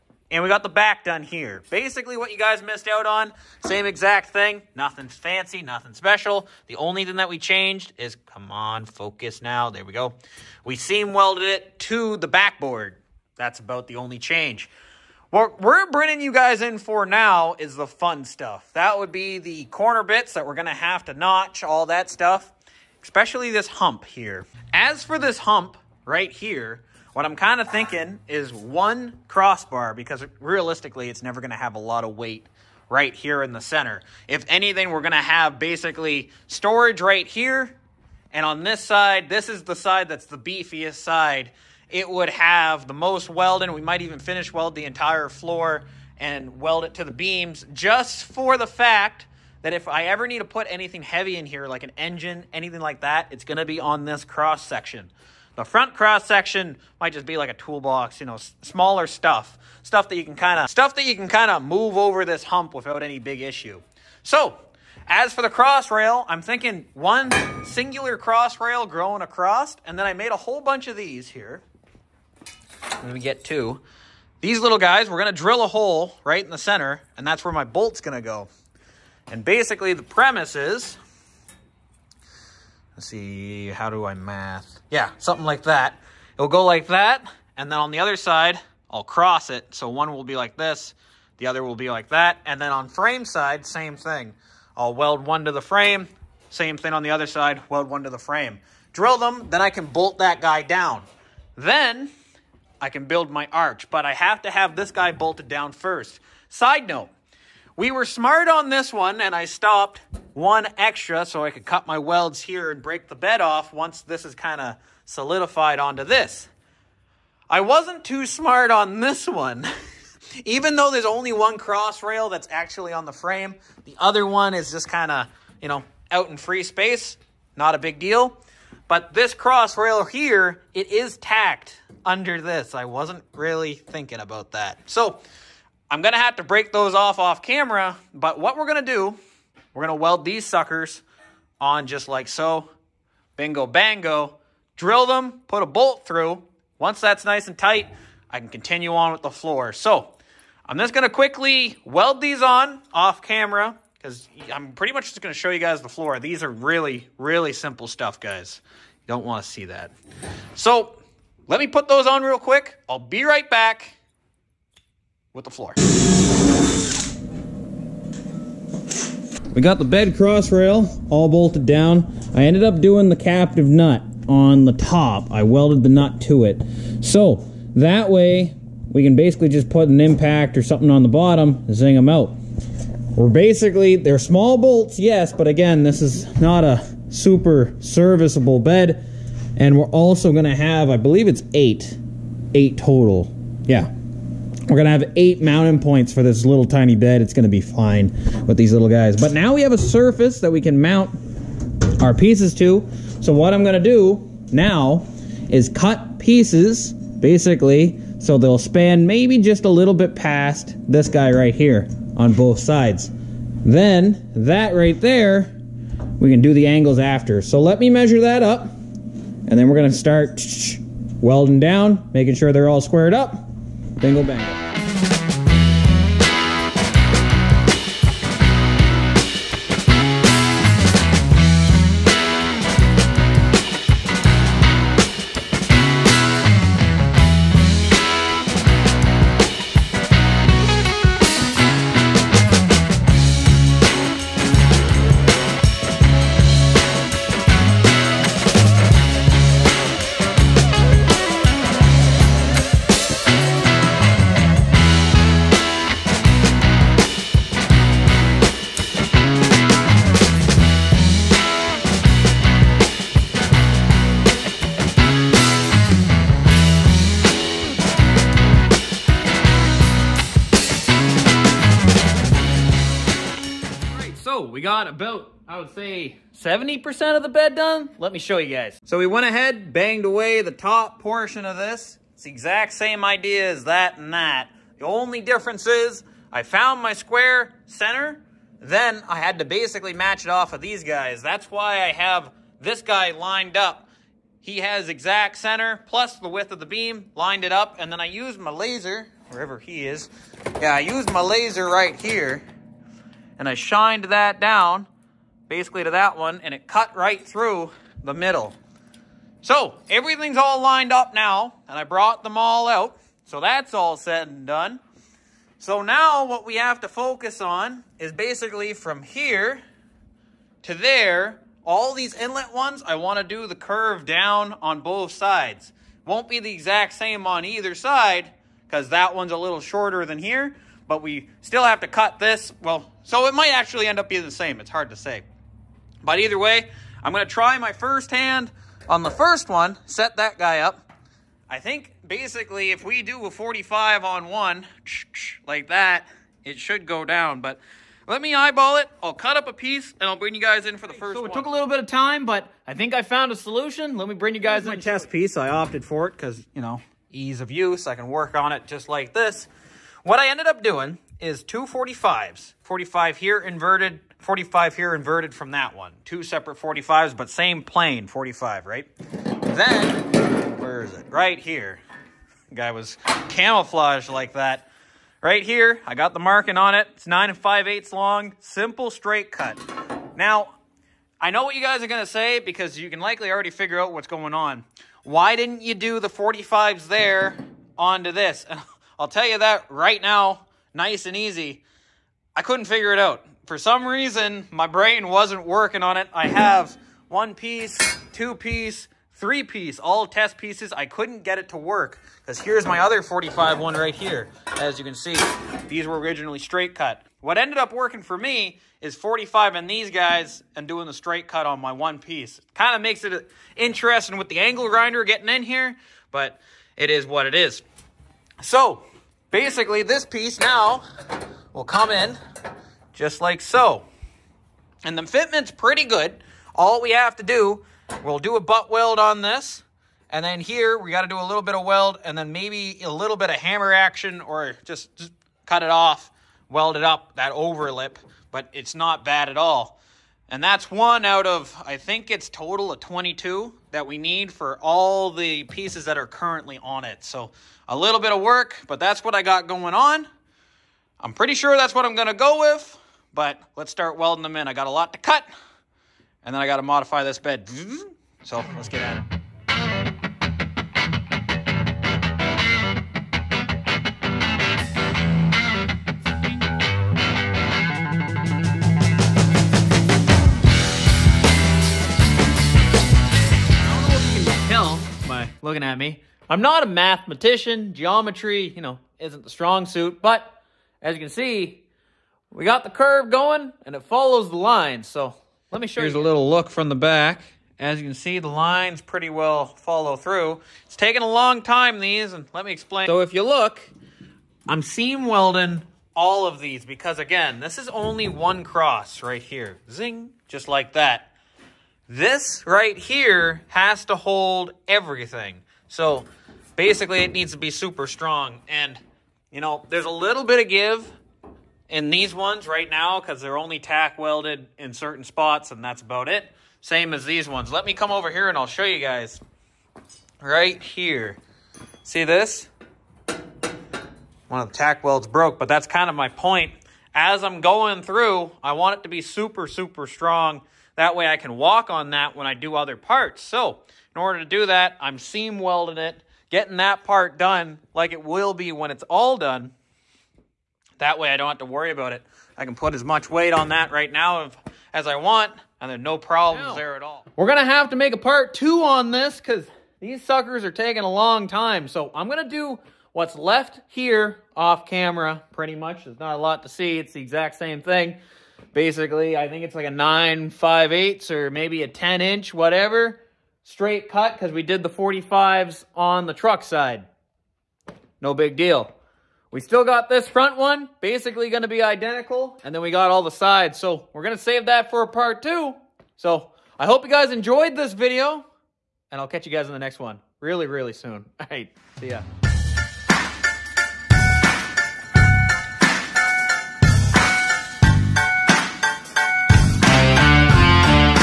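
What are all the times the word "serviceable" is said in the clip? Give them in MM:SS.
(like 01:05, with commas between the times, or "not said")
03:07.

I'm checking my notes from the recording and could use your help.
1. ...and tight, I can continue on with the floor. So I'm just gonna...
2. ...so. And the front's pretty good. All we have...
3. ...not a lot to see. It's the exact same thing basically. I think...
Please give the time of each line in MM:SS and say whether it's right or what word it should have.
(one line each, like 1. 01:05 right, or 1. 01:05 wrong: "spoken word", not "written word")
1. 02:27 right
2. 07:03 wrong: "fitment", not "front"
3. 09:15 right.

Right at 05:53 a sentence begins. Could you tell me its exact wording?
Let me bring you guys Here's in.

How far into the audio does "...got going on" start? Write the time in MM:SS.
07:29.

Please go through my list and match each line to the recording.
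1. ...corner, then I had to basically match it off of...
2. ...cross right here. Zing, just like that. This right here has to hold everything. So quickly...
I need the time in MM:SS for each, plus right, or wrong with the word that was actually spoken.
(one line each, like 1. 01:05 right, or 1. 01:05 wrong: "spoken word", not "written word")
1. 04:47 wrong: "center", not "corner"
2. 08:18 wrong: "basically", not "quickly".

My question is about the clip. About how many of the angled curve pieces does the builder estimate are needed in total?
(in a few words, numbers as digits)
22.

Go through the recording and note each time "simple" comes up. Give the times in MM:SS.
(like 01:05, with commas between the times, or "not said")
02:37, 06:18.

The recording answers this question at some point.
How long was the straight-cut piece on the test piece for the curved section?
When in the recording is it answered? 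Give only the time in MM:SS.
06:17.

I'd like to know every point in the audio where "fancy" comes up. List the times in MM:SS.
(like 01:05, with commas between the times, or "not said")
00:05.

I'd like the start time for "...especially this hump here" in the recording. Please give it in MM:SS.
00:23.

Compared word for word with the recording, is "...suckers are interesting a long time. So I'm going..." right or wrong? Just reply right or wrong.
wrong.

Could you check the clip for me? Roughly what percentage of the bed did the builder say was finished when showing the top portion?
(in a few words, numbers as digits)
70%.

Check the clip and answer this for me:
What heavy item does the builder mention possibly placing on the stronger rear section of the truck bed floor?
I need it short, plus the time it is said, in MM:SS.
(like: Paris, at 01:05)
An engine, at 00:51.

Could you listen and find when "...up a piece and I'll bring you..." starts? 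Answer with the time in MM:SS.
05:49.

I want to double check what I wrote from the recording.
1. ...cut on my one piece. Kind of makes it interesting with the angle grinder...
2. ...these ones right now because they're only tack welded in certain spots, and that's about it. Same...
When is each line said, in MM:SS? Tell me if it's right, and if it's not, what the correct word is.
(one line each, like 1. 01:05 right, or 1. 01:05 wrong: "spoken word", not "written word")
1. 06:51 right
2. 08:31 right.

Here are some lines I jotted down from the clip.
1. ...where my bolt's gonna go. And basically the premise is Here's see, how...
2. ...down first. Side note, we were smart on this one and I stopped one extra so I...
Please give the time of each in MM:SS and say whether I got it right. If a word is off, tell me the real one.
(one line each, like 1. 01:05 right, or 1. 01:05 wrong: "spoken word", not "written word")
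1. 01:17 wrong: "Let", not "Here"
2. 01:45 right.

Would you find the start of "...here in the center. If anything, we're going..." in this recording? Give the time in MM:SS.
00:33.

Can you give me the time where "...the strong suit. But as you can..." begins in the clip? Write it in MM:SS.
07:59.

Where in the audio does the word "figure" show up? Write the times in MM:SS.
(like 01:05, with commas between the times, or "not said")
06:23, 06:32.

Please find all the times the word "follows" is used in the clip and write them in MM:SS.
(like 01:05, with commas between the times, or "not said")
08:03, 08:09.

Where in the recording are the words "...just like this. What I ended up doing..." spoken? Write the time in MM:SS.
05:58.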